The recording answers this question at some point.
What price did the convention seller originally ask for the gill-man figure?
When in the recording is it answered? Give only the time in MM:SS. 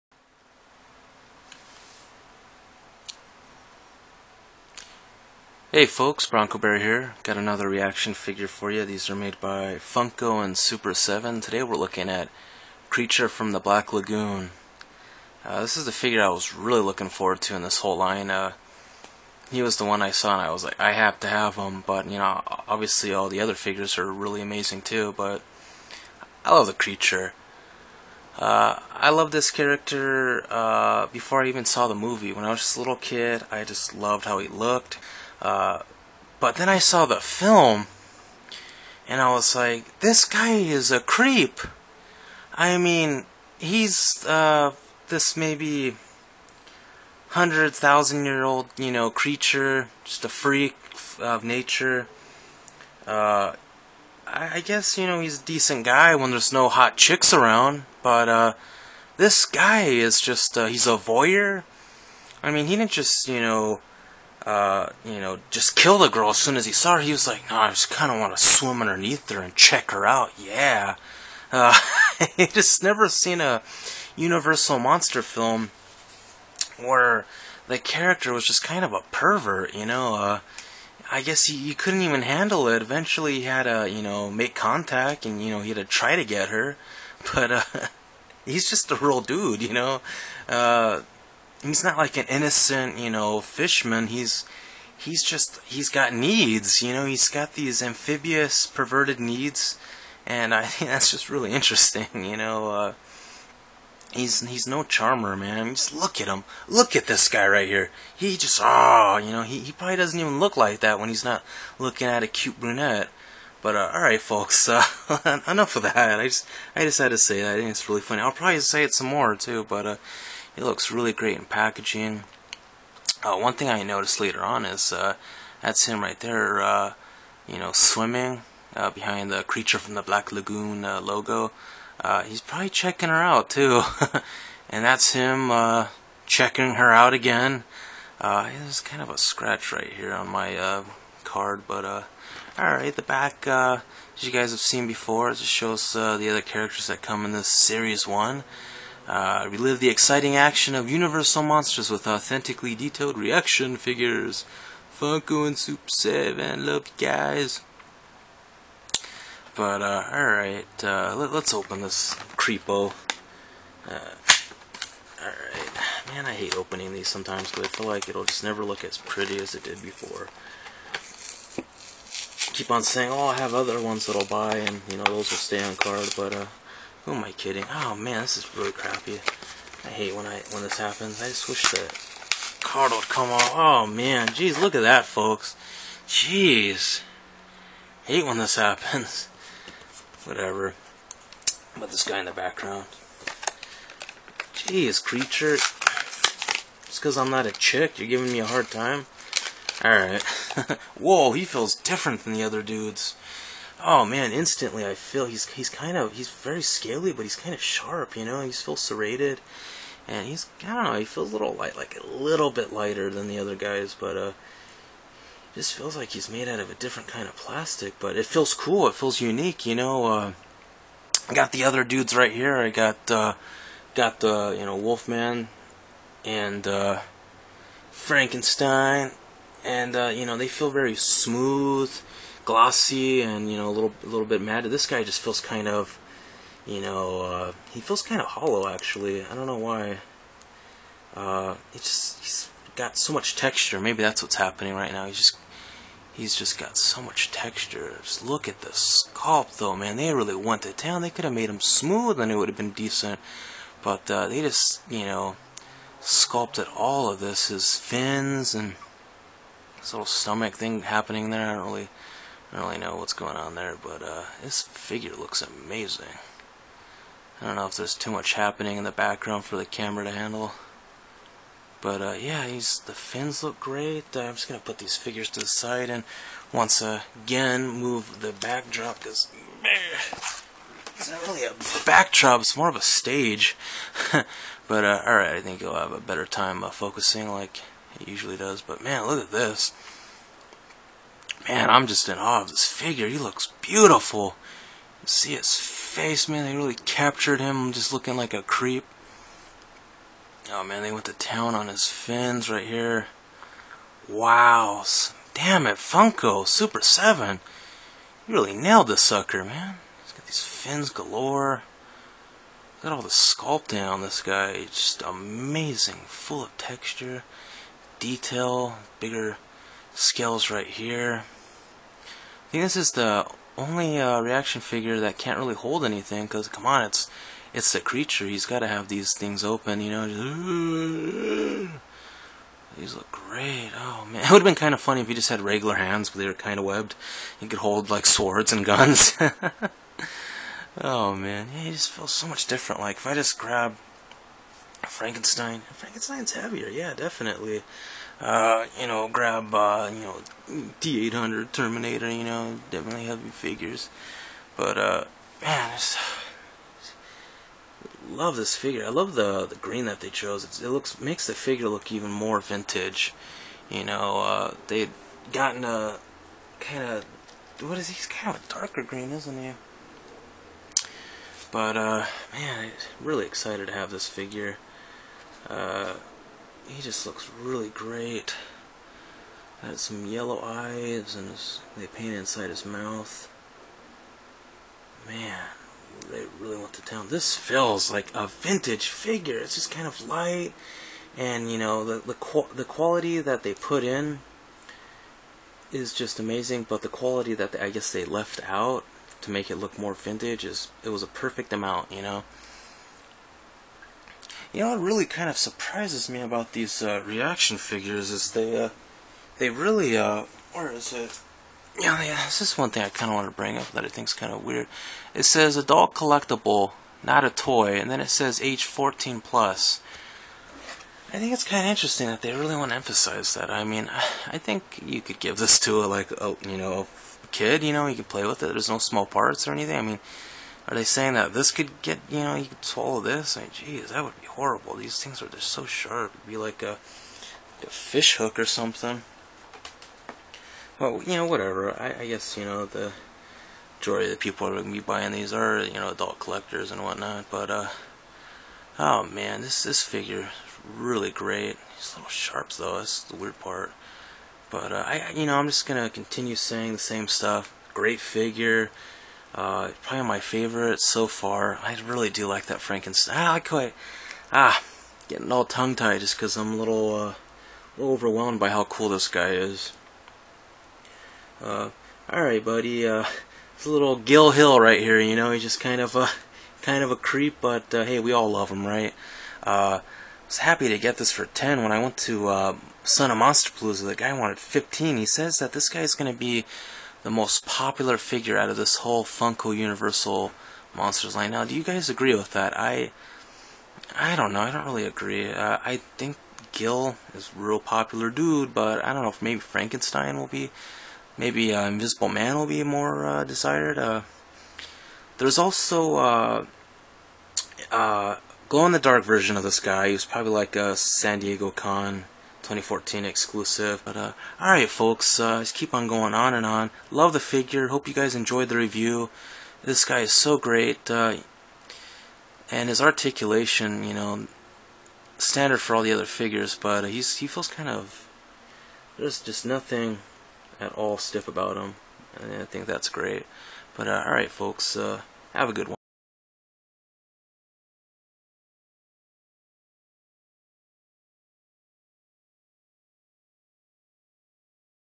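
08:04.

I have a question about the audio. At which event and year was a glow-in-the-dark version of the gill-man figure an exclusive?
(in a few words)
San Diego Con 2014.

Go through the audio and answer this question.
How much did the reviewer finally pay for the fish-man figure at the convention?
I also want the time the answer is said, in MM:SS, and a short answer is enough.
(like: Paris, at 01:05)
10, at 08:01.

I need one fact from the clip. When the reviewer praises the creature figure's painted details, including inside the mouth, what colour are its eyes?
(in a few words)
Yellow.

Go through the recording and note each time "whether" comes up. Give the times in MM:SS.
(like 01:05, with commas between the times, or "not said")
not said.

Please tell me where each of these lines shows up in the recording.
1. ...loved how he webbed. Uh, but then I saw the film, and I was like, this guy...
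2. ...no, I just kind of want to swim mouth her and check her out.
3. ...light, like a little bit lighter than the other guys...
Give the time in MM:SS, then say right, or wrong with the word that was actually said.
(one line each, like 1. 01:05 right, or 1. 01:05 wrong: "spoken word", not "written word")
1. 00:33 wrong: "looked", not "webbed"
2. 01:07 wrong: "underneath", not "mouth"
3. 03:31 right.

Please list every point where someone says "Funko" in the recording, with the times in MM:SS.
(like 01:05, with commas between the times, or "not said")
00:09, 02:34, 05:05, 08:09.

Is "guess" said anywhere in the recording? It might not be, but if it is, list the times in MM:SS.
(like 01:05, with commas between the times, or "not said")
00:54, 01:21, 06:37, 07:22.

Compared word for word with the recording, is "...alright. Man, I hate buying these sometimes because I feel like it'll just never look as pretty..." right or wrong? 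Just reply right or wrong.
wrong.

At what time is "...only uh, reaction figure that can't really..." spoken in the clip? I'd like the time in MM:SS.
05:23.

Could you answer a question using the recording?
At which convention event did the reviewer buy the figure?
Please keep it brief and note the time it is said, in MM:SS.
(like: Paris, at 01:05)
Son of Monster Palooza, at 08:02.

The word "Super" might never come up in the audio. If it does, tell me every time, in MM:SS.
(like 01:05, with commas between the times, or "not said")
00:10, 02:35, 05:06.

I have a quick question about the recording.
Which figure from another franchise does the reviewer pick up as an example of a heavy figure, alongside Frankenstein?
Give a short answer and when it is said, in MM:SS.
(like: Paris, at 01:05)
T800 Terminator, at 05:50.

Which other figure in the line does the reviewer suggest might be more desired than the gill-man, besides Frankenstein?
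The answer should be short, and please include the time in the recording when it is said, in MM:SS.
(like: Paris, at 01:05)
Invisible Man, at 08:21.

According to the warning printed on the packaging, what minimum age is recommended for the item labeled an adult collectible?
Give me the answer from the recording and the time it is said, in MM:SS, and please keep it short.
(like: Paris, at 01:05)
14+, at 06:58.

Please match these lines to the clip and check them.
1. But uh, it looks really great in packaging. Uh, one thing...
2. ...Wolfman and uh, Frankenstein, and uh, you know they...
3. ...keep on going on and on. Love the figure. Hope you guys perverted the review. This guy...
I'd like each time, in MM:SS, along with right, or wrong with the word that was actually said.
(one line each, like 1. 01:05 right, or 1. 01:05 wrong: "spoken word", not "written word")
1. 01:59 right
2. 03:44 right
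3. 08:35 wrong: "enjoyed", not "perverted".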